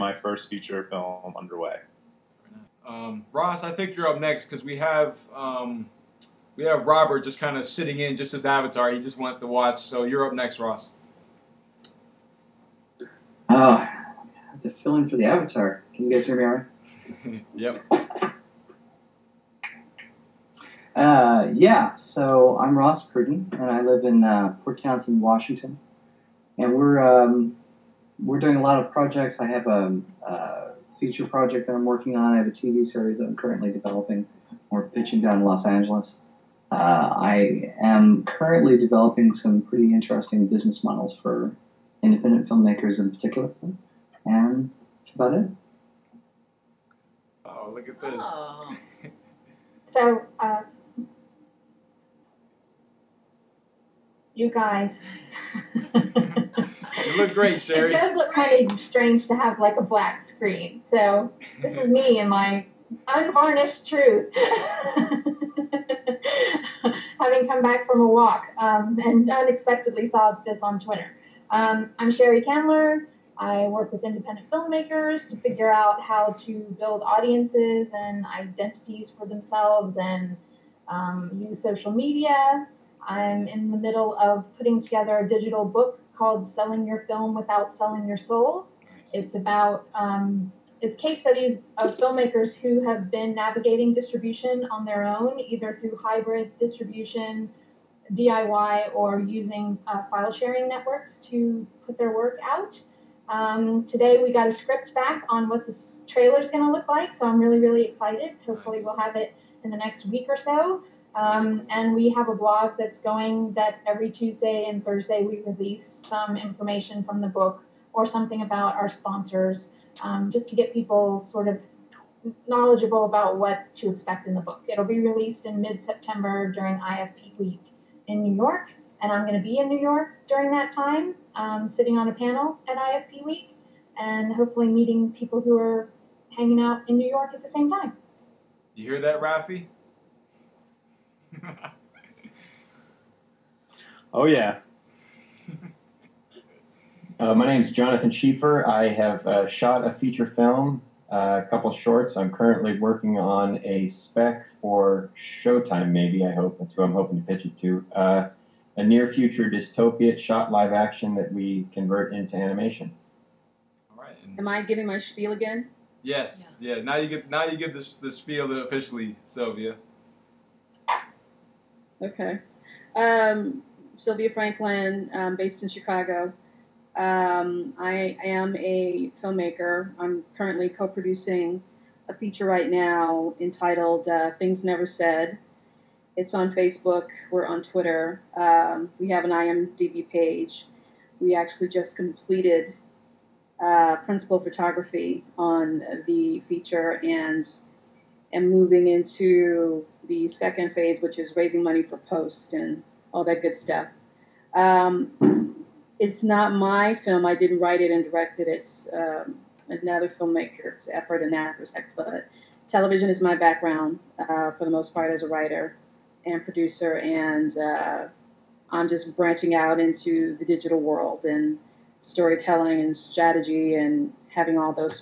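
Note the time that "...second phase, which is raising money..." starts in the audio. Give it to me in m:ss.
3:20.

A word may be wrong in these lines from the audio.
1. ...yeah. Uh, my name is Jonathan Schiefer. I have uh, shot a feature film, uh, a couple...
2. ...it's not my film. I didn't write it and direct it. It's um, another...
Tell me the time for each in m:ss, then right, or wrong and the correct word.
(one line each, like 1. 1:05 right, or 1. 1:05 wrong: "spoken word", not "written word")
1. 2:24 right
2. 3:25 right.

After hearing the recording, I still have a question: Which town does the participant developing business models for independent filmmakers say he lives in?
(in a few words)
Port Townsend, Washington.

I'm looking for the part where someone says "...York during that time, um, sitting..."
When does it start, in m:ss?
2:09.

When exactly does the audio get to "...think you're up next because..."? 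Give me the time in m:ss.
0:03.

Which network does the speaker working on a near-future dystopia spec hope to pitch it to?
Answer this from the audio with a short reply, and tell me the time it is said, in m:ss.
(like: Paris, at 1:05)
Showtime, at 2:35.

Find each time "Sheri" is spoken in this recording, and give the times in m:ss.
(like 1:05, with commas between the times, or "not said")
0:57, 1:12.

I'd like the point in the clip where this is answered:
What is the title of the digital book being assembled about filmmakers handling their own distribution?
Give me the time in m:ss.
1:26.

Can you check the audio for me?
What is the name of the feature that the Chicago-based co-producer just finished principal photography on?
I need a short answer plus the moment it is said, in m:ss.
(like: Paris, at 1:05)
Things Never Said, at 3:04.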